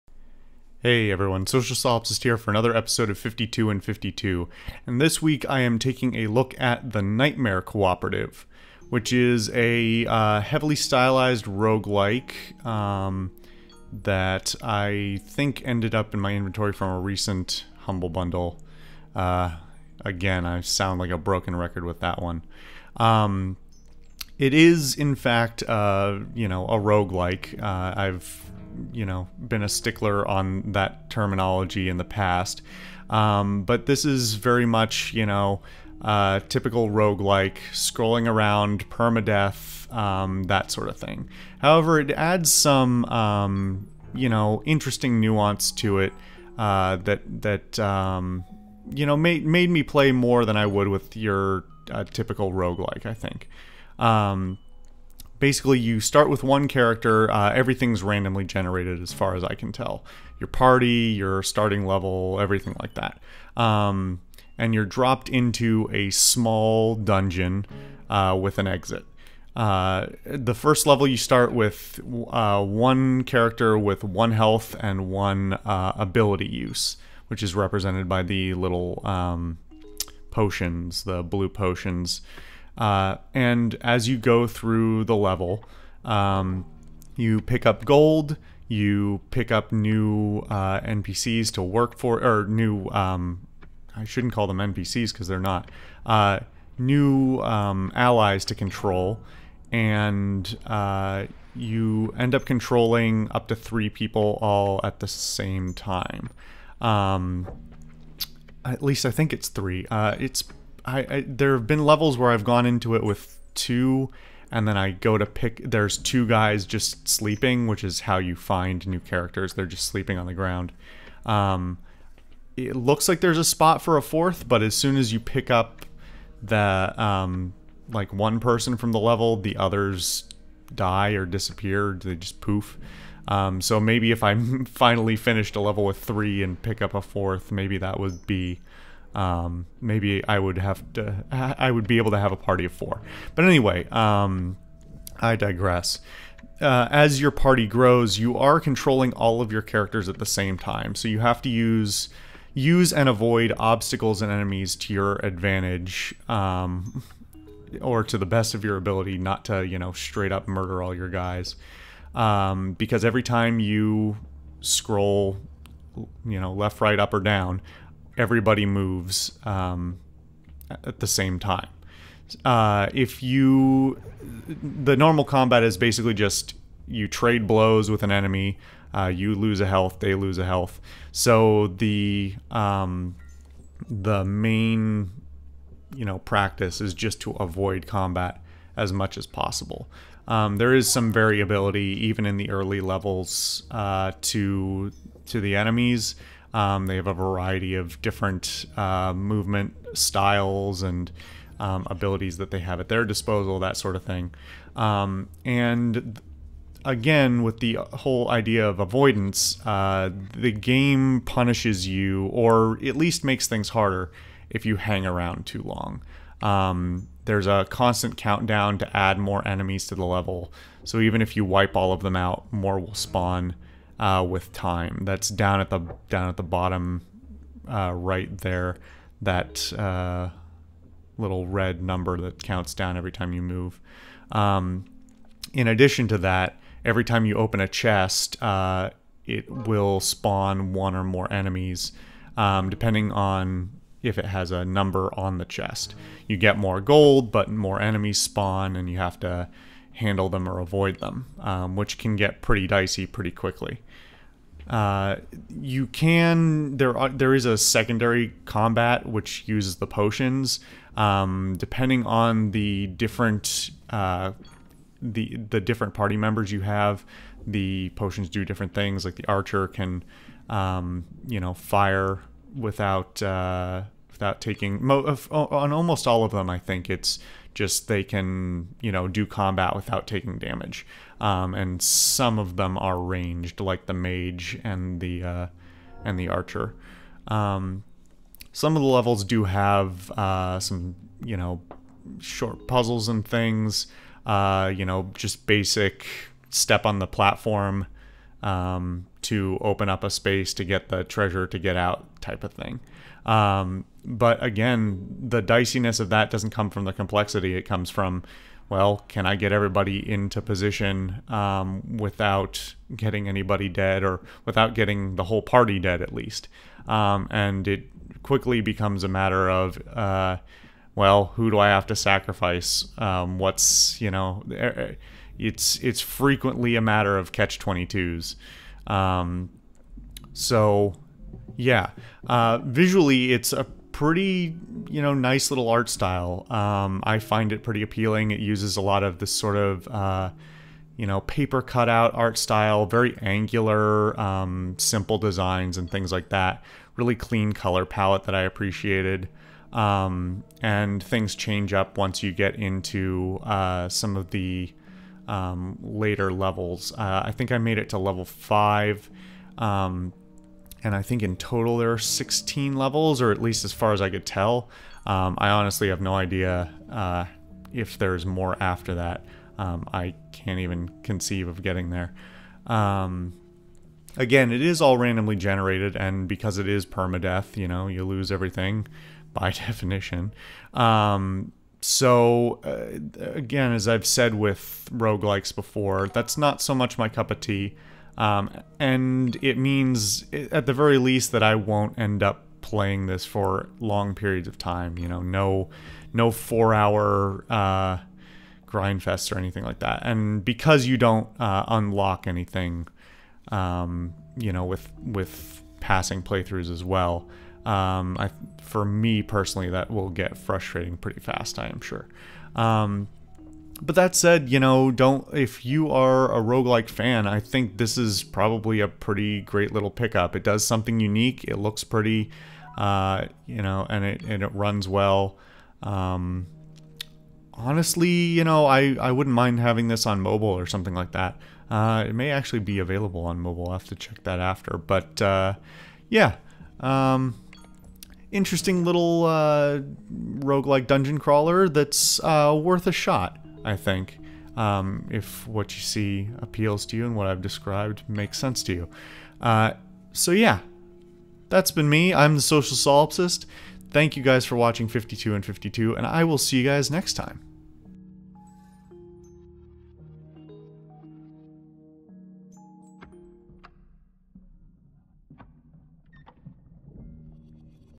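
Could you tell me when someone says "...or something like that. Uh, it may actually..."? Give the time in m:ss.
7:10.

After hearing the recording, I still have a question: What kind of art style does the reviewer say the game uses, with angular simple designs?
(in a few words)
paper cutout.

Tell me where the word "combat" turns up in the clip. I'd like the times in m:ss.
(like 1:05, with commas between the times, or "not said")
2:55, 3:07, 4:18, 4:39.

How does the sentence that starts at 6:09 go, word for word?
Um, I can't even conceive of getting there.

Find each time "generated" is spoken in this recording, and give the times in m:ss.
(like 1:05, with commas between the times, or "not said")
0:58, 6:15.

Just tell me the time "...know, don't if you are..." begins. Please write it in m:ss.
6:54.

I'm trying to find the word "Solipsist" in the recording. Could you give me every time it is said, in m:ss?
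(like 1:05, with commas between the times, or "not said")
0:01, 7:32.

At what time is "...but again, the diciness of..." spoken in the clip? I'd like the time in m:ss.
5:04.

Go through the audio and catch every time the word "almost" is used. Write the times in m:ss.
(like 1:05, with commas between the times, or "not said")
4:35.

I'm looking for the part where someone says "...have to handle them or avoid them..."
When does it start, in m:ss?
4:08.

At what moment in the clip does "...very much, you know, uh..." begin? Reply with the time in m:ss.
0:34.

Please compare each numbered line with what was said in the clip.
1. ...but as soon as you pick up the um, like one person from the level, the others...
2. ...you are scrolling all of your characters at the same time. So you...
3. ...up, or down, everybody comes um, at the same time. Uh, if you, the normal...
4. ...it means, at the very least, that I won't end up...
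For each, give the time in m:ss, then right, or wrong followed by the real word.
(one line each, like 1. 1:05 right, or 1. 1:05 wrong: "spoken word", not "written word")
1. 2:04 right
2. 2:28 wrong: "controlling", not "scrolling"
3. 2:46 wrong: "moves", not "comes"
4. 6:29 right.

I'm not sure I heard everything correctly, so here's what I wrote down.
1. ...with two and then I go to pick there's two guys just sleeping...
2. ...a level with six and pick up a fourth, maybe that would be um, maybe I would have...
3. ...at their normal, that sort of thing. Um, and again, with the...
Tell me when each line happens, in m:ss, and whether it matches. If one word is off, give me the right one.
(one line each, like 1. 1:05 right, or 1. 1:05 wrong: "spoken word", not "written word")
1. 1:53 right
2. 2:15 wrong: "three", not "six"
3. 3:22 wrong: "disposal", not "normal".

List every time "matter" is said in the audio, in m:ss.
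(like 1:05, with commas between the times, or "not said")
5:19, 5:26.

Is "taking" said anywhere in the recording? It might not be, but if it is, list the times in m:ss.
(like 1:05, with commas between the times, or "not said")
0:05, 4:34, 4:40.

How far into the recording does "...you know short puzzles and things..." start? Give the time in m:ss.
4:51.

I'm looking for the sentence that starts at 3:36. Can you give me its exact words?
Um, there's a constant countdown to add more enemies to the level.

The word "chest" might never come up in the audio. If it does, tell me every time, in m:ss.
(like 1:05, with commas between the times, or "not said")
3:57, 4:05.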